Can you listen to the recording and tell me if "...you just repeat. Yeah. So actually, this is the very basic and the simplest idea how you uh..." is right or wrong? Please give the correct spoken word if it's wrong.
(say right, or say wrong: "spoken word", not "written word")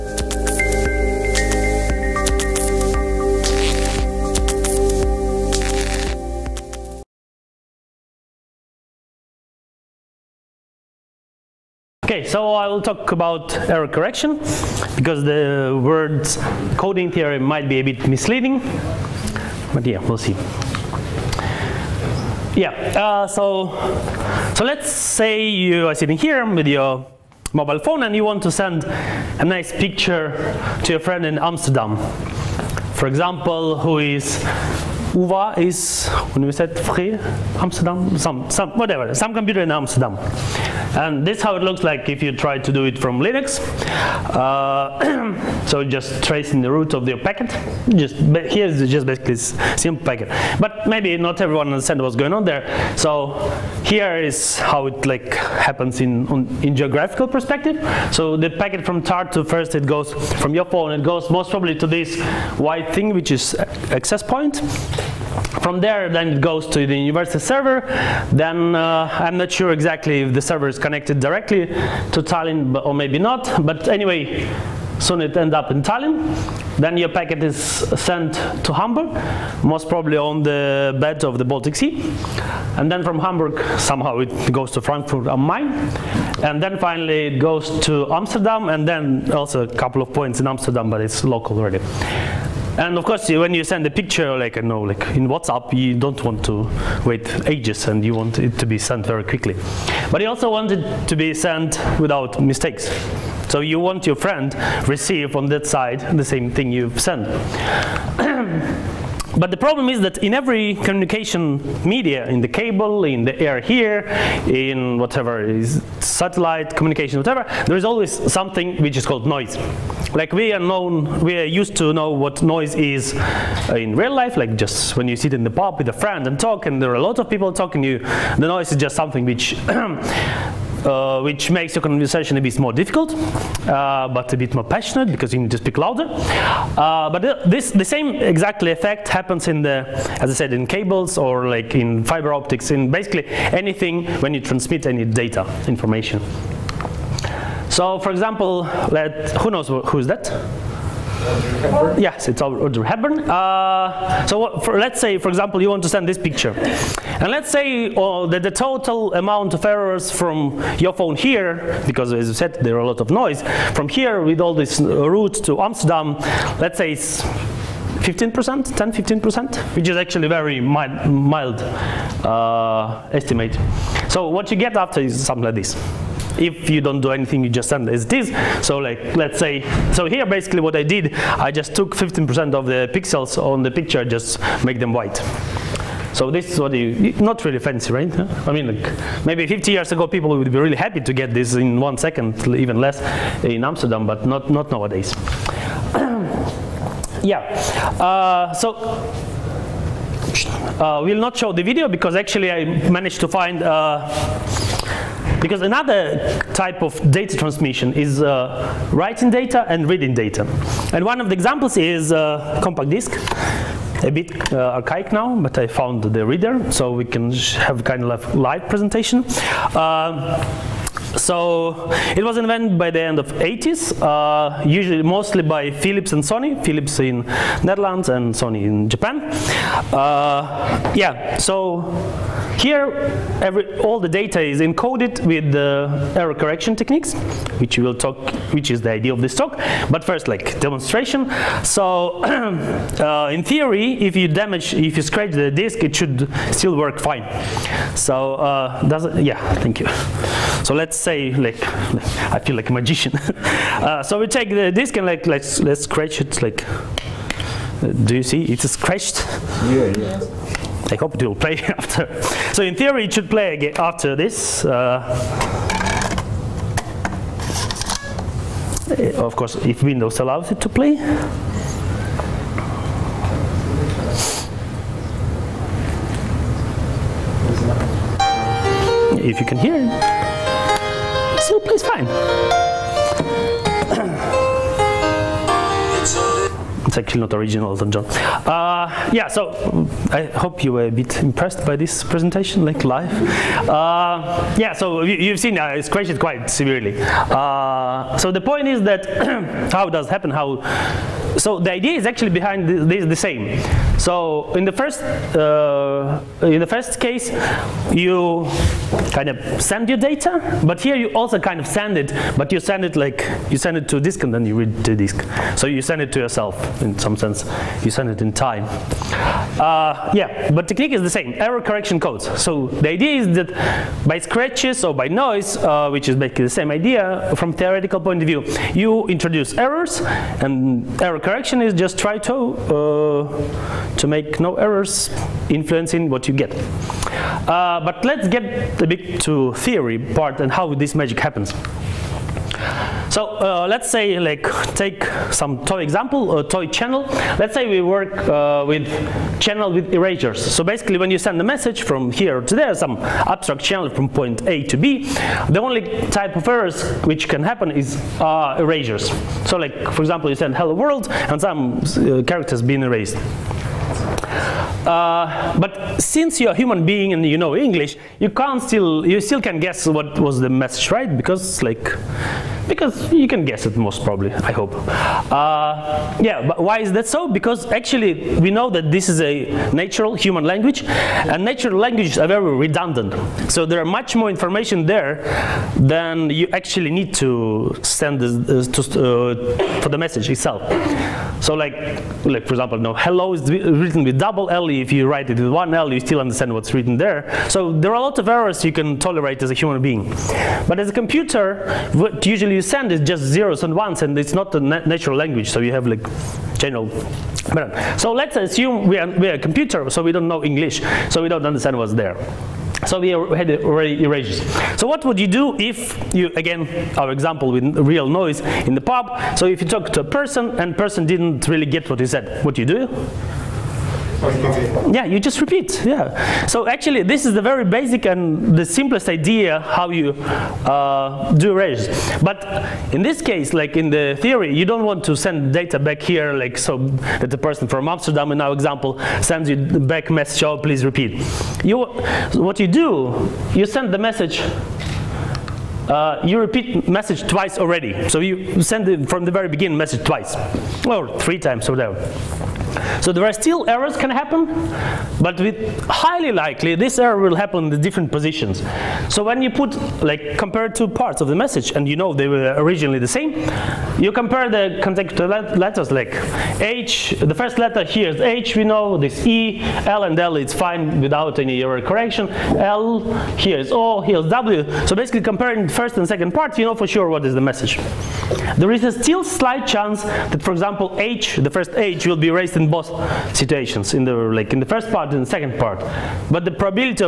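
right.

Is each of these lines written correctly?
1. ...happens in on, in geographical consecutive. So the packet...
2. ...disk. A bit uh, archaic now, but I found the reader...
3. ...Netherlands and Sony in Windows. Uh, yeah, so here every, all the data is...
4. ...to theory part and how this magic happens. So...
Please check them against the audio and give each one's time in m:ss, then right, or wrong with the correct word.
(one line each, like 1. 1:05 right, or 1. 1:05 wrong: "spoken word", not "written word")
1. 0:55 wrong: "perspective", not "consecutive"
2. 3:32 right
3. 3:47 wrong: "Japan", not "Windows"
4. 5:39 right.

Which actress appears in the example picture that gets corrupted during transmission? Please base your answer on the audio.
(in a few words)
Audrey Hepburn.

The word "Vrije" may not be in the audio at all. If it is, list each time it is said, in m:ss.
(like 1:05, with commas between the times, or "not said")
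0:36.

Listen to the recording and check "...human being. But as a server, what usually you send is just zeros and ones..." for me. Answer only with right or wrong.
wrong.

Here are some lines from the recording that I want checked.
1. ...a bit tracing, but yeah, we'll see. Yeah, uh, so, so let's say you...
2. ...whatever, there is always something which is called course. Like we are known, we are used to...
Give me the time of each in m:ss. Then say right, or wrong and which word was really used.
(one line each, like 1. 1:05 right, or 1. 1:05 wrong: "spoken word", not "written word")
1. 0:17 wrong: "misleading", not "tracing"
2. 1:57 wrong: "noise", not "course".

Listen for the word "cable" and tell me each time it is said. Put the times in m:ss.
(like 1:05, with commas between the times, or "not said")
1:52, 2:20.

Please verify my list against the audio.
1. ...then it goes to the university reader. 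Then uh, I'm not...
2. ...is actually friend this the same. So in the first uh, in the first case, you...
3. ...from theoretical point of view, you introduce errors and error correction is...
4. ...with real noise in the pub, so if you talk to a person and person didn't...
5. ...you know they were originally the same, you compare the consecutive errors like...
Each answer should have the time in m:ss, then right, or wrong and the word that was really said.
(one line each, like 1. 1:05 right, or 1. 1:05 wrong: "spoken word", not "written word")
1. 1:06 wrong: "server", not "reader"
2. 5:01 wrong: "behind", not "friend"
3. 5:27 right
4. 6:57 right
5. 7:41 wrong: "letters", not "errors".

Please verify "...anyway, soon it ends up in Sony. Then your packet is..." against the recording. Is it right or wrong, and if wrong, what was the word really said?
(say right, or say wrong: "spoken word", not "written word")
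wrong: "Tallinn", not "Sony".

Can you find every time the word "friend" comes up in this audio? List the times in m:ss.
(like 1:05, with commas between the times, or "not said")
0:30, 1:44, 2:05.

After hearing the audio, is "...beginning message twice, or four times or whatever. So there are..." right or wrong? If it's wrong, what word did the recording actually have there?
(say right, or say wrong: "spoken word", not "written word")
wrong: "three", not "four".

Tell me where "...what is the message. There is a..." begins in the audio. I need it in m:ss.
7:57.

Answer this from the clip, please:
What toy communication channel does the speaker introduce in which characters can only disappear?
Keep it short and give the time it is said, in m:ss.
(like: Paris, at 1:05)
Channel with erasures, at 5:49.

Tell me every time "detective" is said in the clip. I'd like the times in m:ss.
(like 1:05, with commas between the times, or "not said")
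not said.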